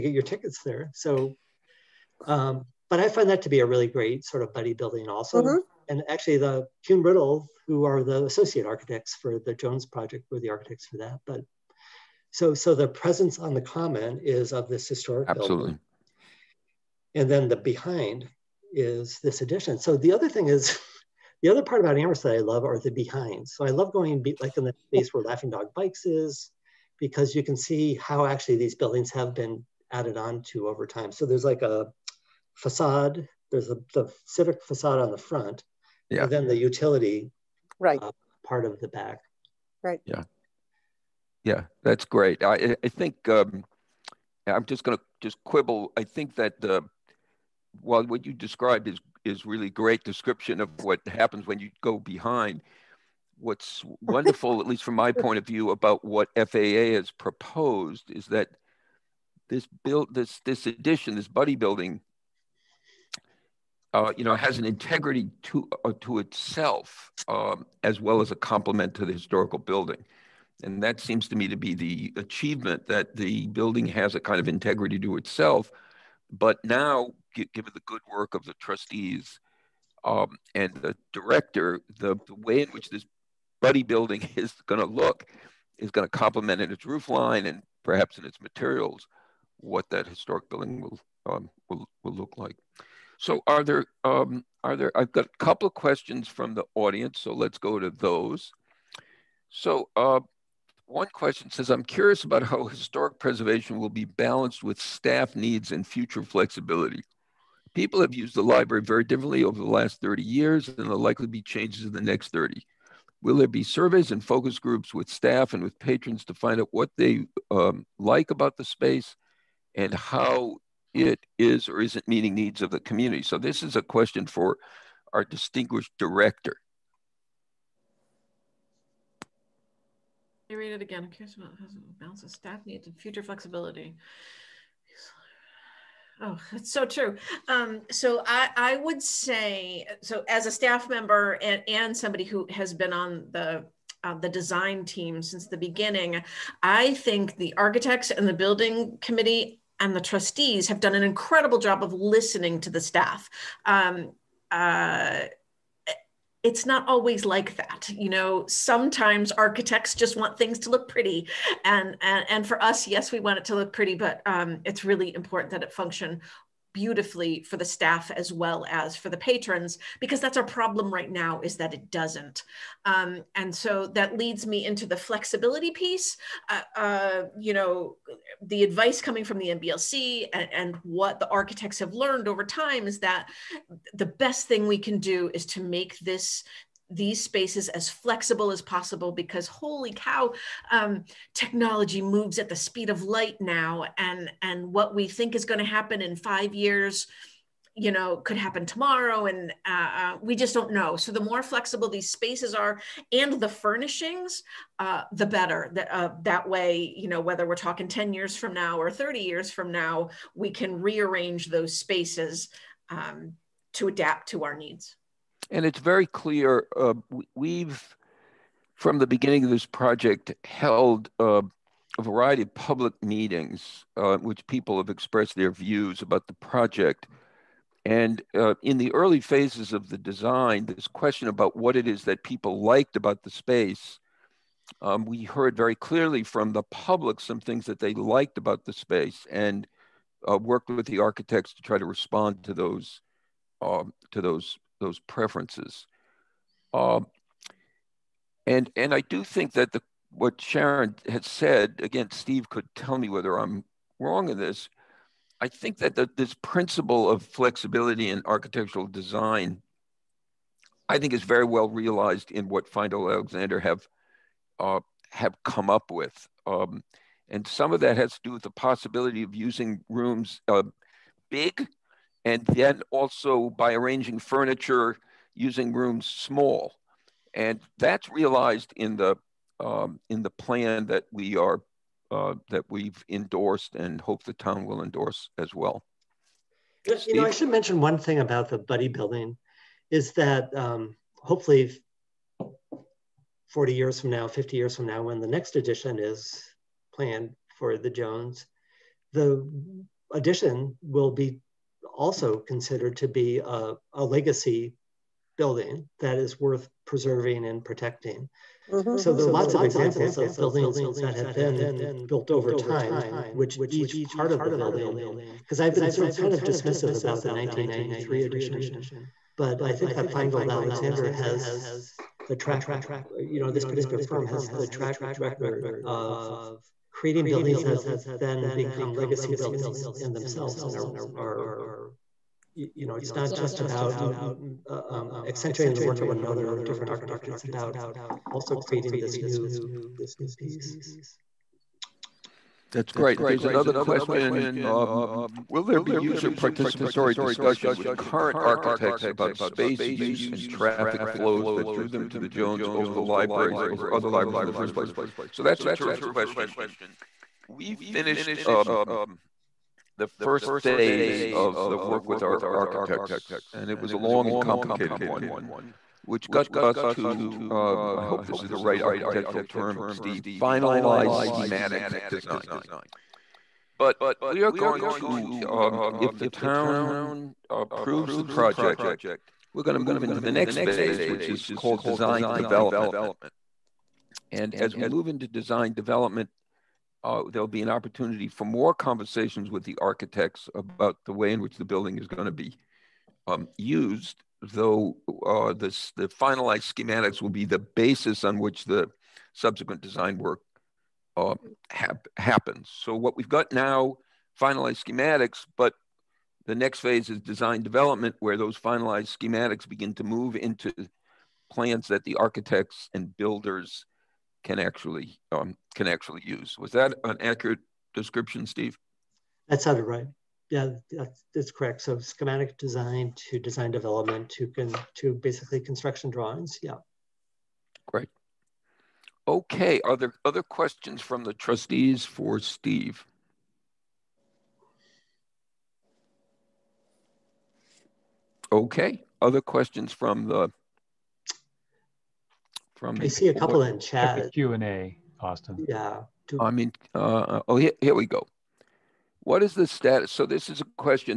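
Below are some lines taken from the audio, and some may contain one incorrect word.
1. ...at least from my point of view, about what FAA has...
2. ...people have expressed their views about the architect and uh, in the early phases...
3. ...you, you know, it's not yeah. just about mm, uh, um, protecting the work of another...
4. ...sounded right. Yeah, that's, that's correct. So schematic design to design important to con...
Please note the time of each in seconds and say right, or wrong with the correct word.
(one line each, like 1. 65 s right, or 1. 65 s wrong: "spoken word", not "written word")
1. 54 s right
2. 224 s wrong: "project", not "architect"
3. 332 s wrong: "accentuating", not "protecting"
4. 419 s wrong: "development", not "important".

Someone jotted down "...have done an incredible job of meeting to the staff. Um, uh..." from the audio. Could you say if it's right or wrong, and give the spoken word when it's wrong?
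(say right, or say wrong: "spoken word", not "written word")
wrong: "listening", not "meeting".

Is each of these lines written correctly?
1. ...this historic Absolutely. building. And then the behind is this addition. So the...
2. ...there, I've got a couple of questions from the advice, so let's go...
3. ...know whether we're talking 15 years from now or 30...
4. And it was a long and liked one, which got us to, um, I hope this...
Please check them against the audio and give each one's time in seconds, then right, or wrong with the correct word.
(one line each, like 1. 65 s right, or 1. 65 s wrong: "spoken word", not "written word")
1. 14 s right
2. 94 s wrong: "audience", not "advice"
3. 207 s wrong: "10", not "15"
4. 363 s wrong: "complicated", not "liked".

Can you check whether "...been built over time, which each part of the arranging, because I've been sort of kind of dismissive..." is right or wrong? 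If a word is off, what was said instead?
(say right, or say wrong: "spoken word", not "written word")
wrong: "building", not "arranging".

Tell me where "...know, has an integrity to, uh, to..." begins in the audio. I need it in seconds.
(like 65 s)
64 s.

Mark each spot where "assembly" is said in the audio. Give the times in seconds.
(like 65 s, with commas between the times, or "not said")
not said.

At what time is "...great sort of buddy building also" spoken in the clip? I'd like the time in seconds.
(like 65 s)
3 s.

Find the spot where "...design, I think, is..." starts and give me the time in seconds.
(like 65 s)
258 s.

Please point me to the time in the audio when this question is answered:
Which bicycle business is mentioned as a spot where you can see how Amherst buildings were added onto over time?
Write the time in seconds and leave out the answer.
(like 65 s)
25 s.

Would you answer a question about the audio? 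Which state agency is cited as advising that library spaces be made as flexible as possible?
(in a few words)
MBLC.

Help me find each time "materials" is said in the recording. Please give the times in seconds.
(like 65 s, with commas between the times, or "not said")
88 s.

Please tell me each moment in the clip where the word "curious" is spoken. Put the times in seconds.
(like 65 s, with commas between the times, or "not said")
101 s, 131 s.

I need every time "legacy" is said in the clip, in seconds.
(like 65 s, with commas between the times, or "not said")
304 s, 328 s.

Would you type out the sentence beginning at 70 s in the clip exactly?
And that seems to me to be the achievement that the building has a kind of integrity to itself.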